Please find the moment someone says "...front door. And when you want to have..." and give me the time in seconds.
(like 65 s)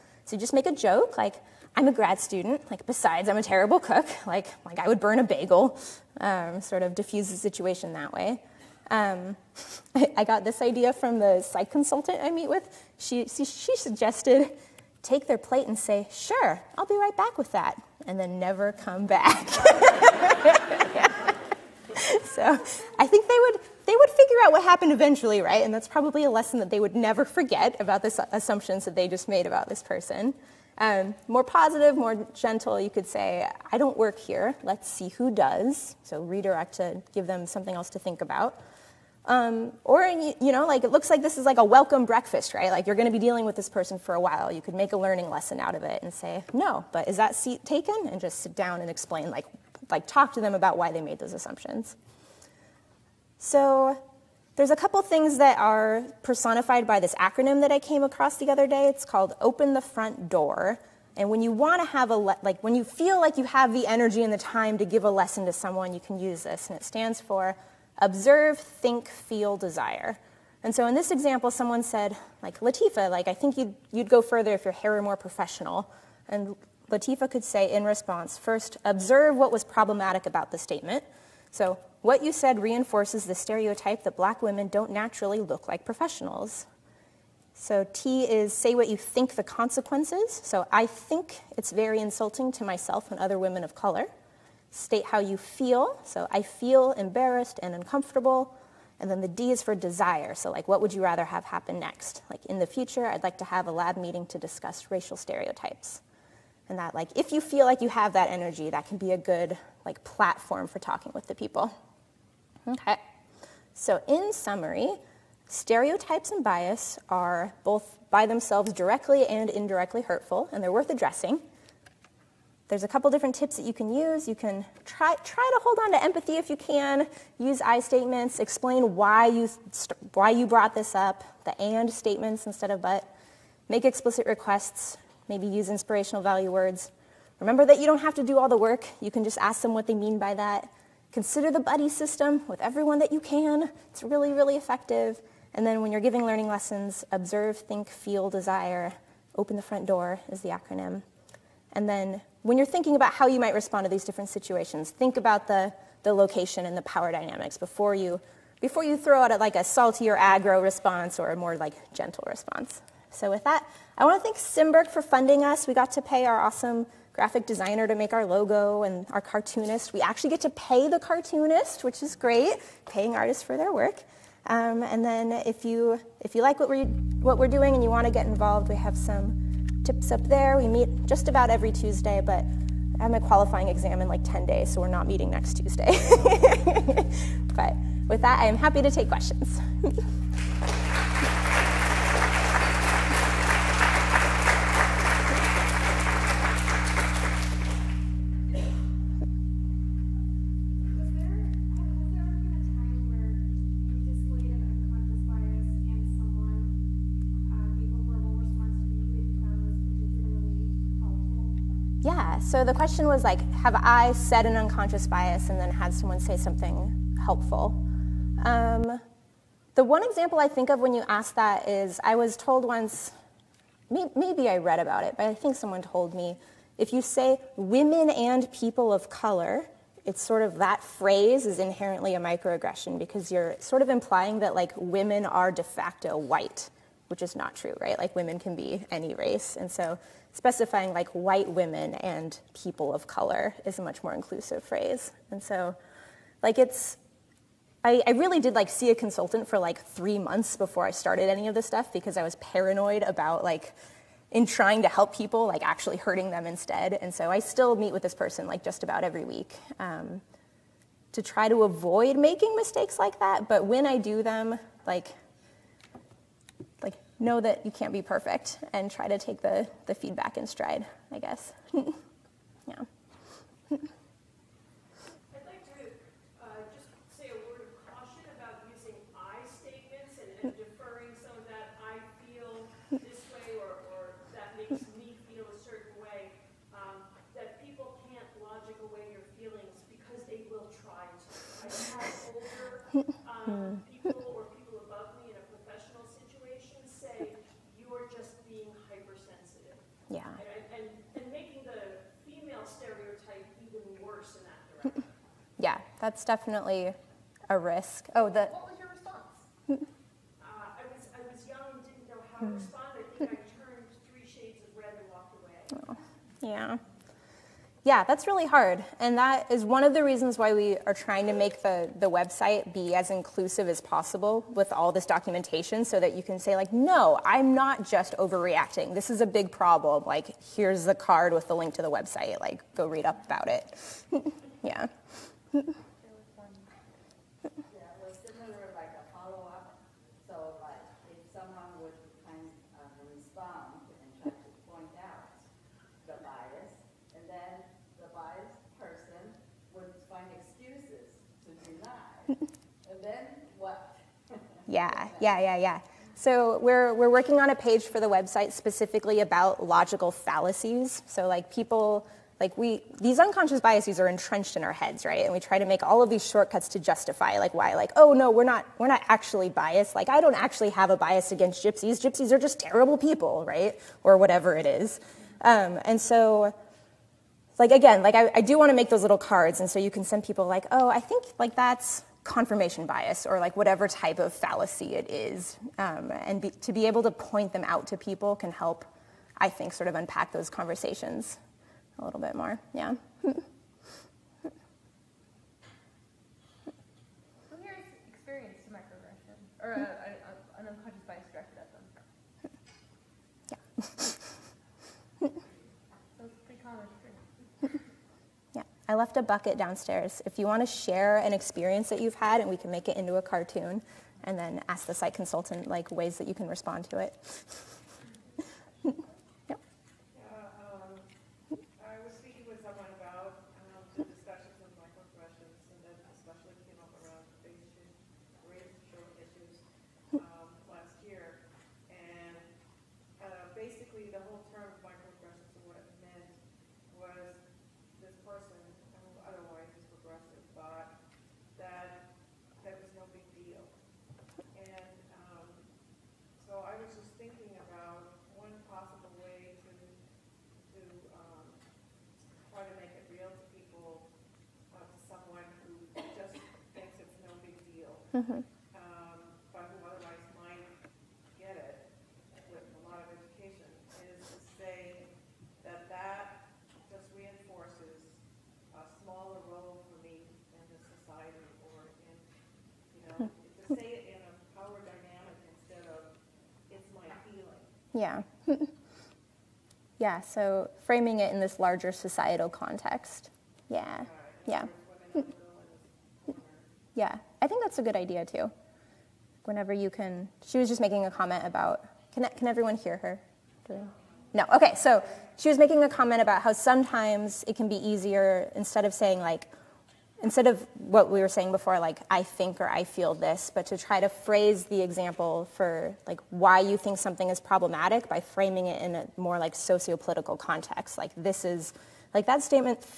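59 s.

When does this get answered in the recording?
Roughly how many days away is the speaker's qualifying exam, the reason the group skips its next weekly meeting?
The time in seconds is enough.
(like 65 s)
184 s.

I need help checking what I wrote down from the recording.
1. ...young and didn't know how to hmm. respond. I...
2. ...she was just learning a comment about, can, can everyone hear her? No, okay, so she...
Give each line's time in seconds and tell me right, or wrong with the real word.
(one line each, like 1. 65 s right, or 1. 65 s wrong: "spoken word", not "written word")
1. 311 s right
2. 490 s wrong: "making", not "learning".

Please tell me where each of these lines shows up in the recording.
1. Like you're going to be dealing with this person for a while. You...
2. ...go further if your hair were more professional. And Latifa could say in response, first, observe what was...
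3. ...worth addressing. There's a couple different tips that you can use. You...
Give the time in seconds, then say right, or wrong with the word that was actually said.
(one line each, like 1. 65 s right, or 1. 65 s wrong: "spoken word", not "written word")
1. 42 s right
2. 74 s right
3. 120 s right.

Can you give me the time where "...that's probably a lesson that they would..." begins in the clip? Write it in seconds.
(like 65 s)
25 s.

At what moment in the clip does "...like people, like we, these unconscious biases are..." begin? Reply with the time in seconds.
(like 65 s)
361 s.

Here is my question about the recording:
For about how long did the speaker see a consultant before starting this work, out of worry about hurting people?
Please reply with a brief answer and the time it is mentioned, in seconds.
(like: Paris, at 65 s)
three months, at 249 s.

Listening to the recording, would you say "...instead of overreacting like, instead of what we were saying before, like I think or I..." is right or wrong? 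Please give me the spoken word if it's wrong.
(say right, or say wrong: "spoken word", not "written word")
wrong: "saying", not "overreacting".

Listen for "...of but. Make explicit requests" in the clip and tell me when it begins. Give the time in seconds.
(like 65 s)
132 s.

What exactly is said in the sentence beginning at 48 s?
And just sit down and explain, like, like talk to them about why they made those assumptions.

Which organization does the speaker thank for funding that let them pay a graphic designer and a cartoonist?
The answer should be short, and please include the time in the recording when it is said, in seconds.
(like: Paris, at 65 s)
Simberg, at 164 s.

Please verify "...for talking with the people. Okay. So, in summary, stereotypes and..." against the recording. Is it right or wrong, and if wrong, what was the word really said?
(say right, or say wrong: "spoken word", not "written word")
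right.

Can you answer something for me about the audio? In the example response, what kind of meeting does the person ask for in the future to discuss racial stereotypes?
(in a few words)
lab meeting.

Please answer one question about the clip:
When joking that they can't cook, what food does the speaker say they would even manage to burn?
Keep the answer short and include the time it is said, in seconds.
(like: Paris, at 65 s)
bagel, at 5 s.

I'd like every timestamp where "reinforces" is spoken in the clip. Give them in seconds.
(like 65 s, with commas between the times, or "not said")
82 s, 467 s.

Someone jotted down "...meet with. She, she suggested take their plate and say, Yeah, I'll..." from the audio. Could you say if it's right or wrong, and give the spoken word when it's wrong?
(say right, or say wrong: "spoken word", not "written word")
wrong: "Sure", not "Yeah".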